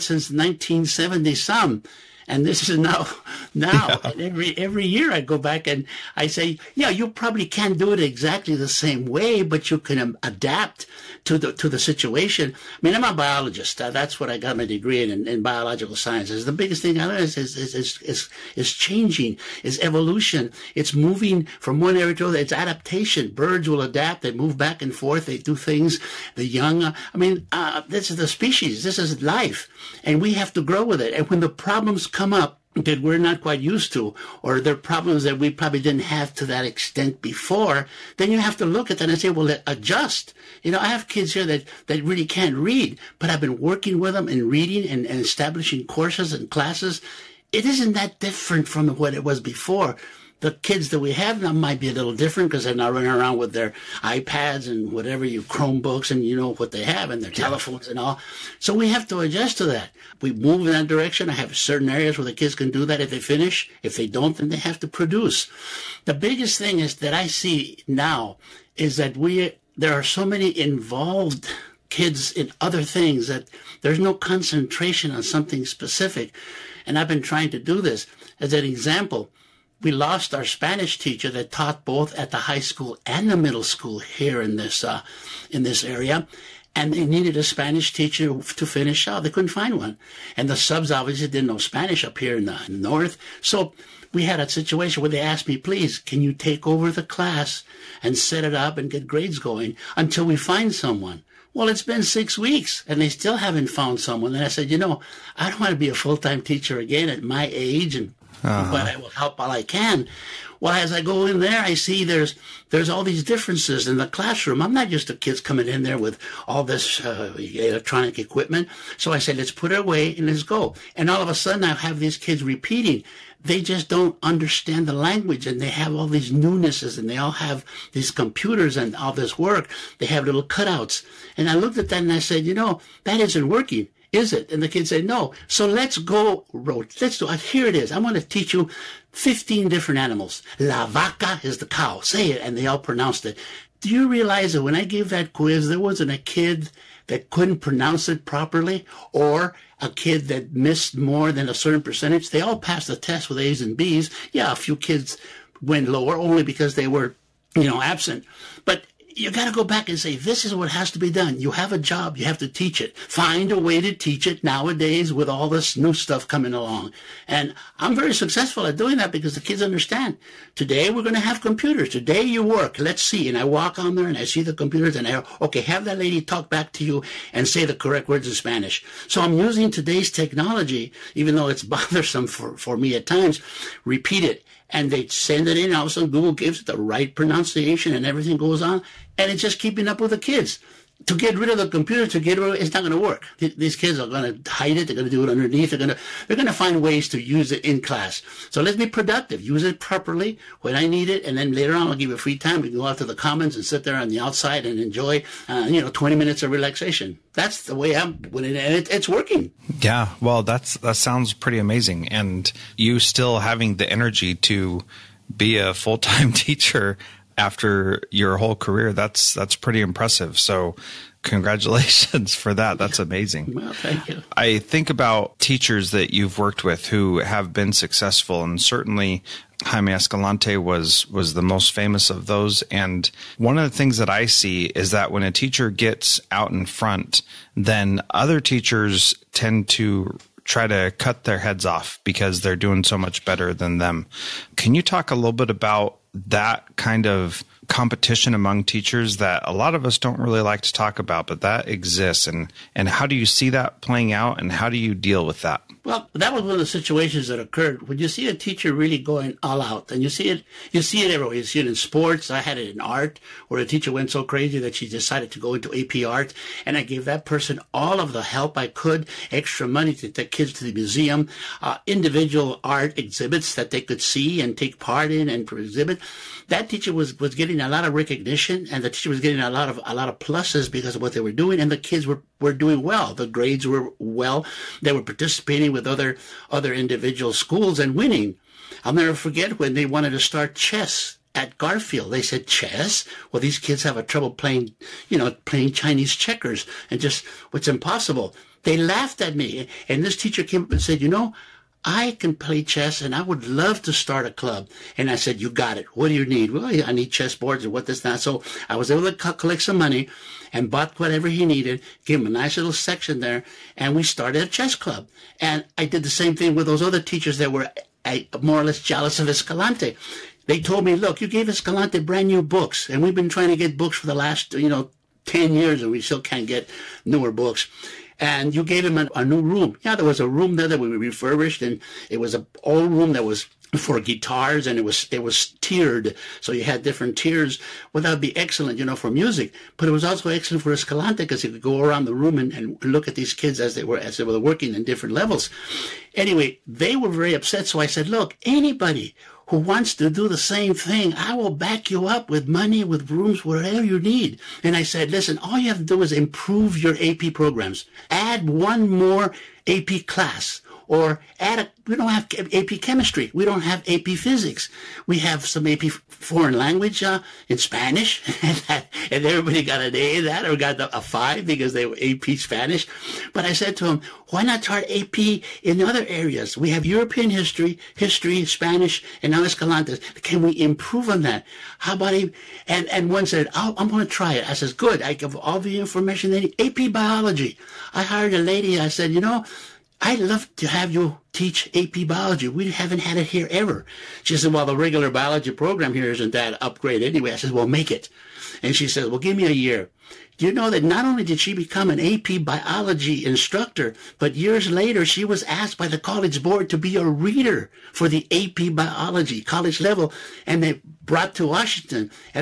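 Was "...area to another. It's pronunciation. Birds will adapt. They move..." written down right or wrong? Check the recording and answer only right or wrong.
wrong.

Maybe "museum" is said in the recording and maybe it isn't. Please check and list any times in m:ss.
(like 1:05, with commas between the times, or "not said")
4:30.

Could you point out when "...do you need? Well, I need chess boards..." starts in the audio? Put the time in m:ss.
5:06.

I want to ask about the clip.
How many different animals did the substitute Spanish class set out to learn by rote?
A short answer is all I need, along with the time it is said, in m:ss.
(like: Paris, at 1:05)
15, at 2:19.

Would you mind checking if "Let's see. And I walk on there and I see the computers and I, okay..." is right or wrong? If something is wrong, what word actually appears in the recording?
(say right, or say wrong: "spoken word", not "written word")
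right.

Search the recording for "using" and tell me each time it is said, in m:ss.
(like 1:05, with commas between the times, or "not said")
2:59.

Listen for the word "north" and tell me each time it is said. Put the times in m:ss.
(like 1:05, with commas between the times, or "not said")
1:32.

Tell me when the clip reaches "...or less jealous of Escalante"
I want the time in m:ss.
5:18.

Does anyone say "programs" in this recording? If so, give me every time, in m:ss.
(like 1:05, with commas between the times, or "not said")
5:57, 6:35.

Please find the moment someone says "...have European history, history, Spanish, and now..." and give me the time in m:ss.
6:16.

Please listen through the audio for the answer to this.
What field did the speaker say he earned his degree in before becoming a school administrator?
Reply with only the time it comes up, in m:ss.
0:15.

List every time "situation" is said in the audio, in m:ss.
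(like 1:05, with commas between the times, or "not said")
0:11, 1:34, 4:16.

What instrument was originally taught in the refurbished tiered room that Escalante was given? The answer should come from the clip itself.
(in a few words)
Guitars.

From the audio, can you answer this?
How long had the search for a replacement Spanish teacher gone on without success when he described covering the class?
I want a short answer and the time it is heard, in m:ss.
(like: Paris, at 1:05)
Six weeks, at 1:42.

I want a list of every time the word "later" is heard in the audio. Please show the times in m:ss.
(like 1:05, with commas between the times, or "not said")
3:21, 6:44.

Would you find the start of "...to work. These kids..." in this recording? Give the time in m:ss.
3:12.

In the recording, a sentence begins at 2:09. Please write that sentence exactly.
They have little cutouts, and I looked at that and I said, you know, that isn't working is it?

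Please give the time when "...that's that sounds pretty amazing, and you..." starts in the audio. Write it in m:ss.
3:30.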